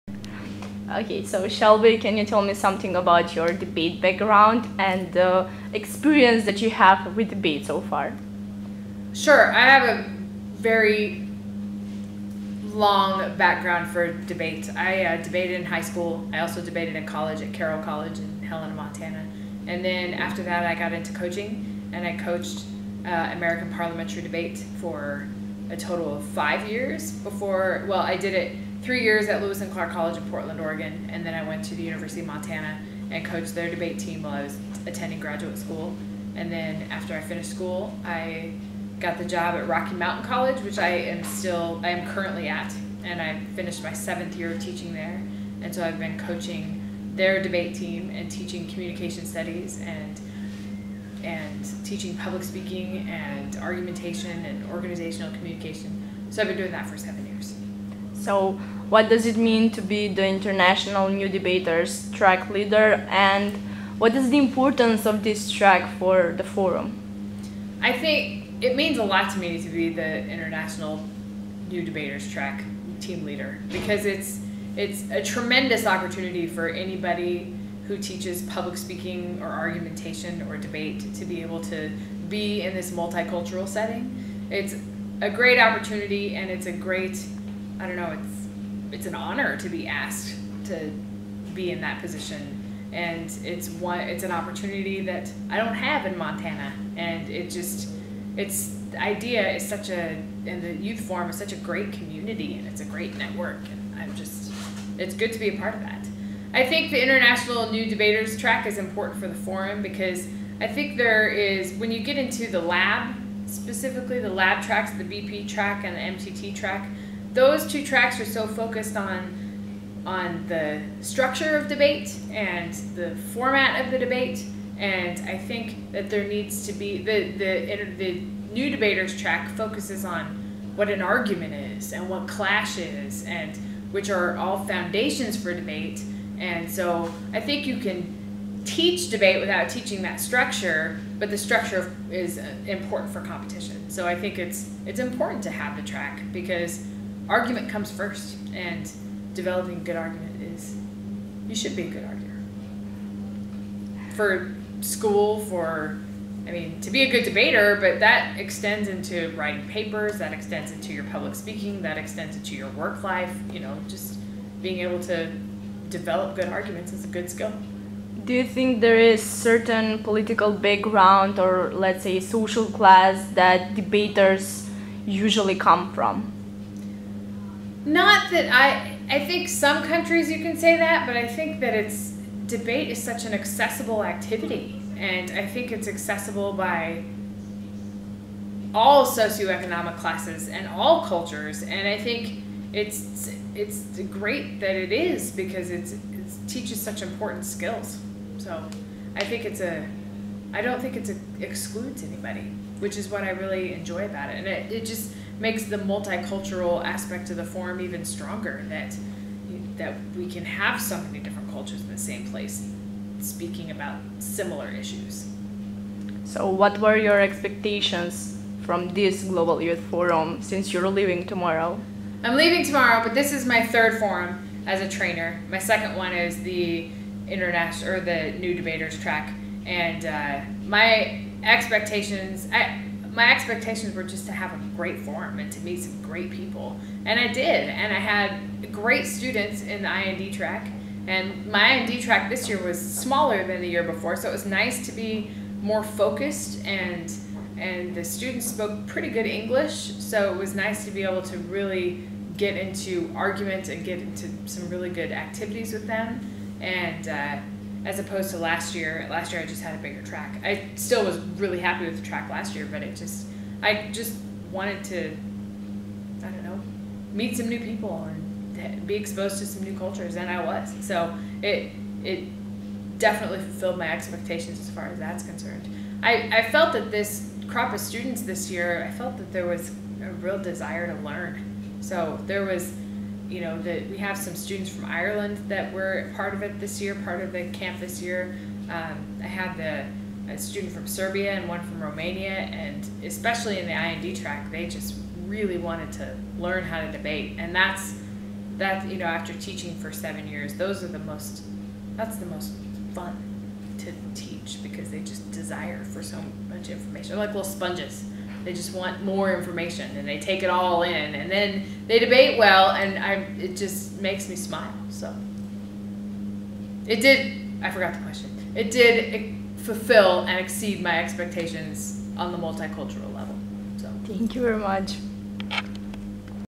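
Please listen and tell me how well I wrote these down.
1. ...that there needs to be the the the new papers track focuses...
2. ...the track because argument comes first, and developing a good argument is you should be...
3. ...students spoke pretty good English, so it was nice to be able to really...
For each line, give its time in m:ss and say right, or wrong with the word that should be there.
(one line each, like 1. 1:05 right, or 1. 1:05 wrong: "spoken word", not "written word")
1. 2:05 wrong: "debaters", not "papers"
2. 2:25 right
3. 4:08 right.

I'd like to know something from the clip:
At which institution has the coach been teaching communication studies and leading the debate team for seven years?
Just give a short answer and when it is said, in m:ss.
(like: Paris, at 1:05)
Rocky Mountain College, at 0:39.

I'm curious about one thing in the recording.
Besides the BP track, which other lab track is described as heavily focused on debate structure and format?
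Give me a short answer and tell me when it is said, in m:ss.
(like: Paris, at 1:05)
MTT track, at 1:56.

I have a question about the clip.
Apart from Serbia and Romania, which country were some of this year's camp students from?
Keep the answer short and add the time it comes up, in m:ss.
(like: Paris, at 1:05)
Ireland, at 4:44.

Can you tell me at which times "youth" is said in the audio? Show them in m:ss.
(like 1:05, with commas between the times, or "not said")
1:40, 3:39.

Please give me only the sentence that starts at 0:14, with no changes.
I uh, debated in high school.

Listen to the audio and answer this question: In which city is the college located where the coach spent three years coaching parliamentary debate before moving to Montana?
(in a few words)
Portland.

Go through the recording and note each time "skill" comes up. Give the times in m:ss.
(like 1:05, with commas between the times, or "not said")
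2:47, 3:17.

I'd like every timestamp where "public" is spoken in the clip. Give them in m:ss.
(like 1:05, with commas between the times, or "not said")
0:52, 1:18, 2:41.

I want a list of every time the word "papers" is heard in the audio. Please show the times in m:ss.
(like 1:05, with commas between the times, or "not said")
2:39.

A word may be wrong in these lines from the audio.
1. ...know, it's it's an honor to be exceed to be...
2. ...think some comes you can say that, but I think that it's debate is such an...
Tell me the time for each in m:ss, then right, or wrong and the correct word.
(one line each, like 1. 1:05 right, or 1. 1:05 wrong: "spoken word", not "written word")
1. 1:27 wrong: "asked", not "exceed"
2. 2:59 wrong: "countries", not "comes".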